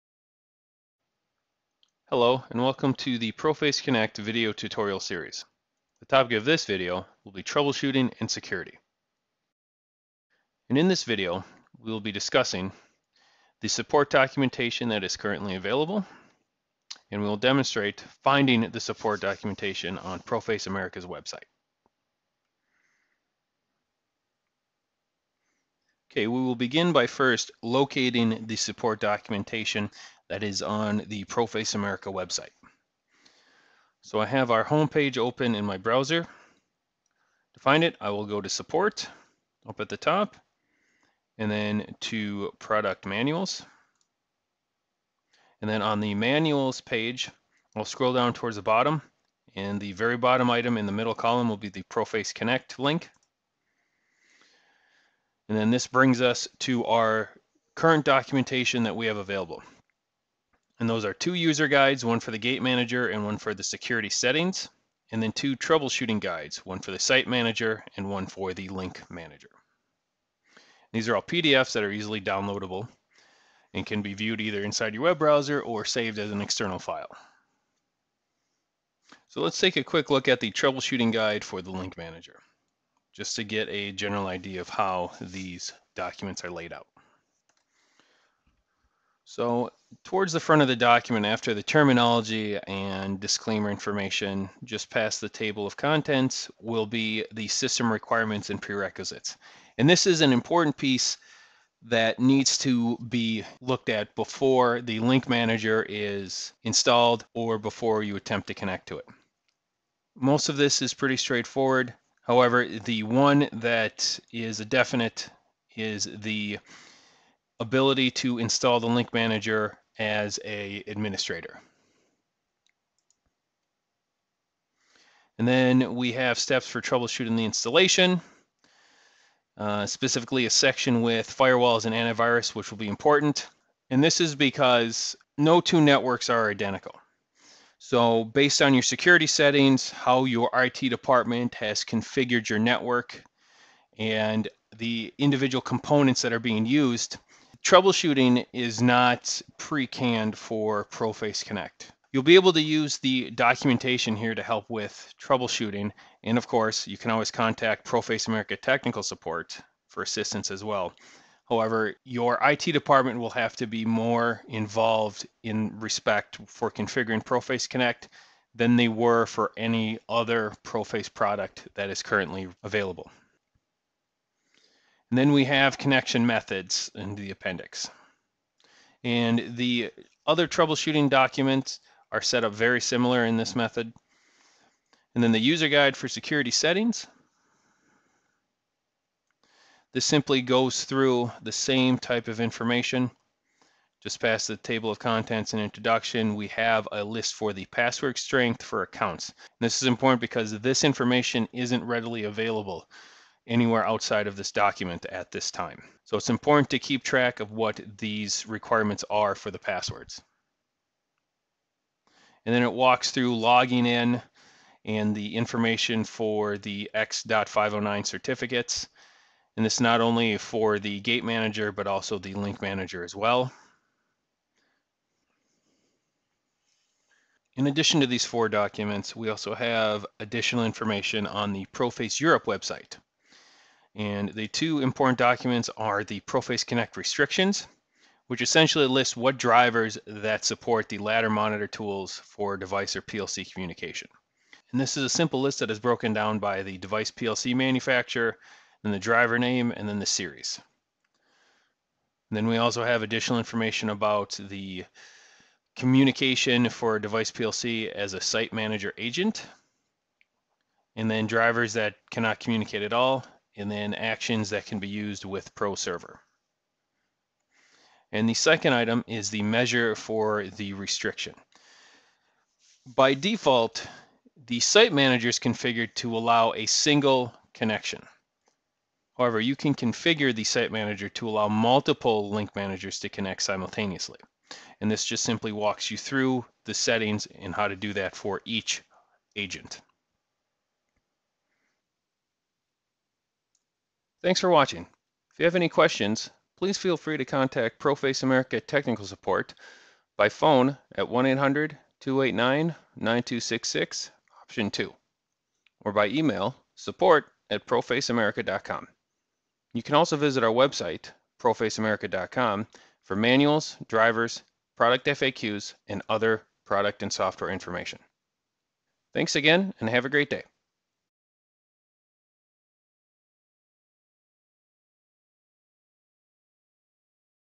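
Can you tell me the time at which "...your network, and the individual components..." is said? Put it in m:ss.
2:22.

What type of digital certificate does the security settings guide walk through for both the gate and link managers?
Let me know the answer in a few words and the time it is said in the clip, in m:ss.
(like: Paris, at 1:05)
X.509, at 3:36.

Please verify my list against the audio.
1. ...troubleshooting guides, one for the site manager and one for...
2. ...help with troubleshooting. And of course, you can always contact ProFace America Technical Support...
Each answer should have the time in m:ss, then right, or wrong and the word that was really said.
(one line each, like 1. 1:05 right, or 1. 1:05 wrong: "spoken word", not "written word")
1. 1:05 right
2. 2:34 right.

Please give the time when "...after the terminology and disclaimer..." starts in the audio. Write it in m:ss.
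1:31.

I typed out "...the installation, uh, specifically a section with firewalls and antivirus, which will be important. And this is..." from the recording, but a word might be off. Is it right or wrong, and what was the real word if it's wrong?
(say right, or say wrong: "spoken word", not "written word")
right.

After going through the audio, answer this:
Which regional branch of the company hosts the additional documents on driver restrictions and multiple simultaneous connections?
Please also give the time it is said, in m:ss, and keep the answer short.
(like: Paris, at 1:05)
ProFace Europe, at 3:51.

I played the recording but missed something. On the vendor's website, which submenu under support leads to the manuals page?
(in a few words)
Product manuals.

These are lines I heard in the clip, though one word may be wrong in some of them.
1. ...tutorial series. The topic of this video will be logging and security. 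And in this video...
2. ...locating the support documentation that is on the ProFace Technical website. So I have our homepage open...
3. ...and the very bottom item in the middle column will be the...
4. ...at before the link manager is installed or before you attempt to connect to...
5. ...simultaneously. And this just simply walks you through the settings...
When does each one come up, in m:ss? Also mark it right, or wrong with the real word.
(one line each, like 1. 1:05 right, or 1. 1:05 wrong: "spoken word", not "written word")
1. 0:04 wrong: "troubleshooting", not "logging"
2. 0:27 wrong: "America", not "Technical"
3. 0:49 right
4. 1:43 right
5. 4:43 right.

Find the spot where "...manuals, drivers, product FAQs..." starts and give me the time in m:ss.
5:13.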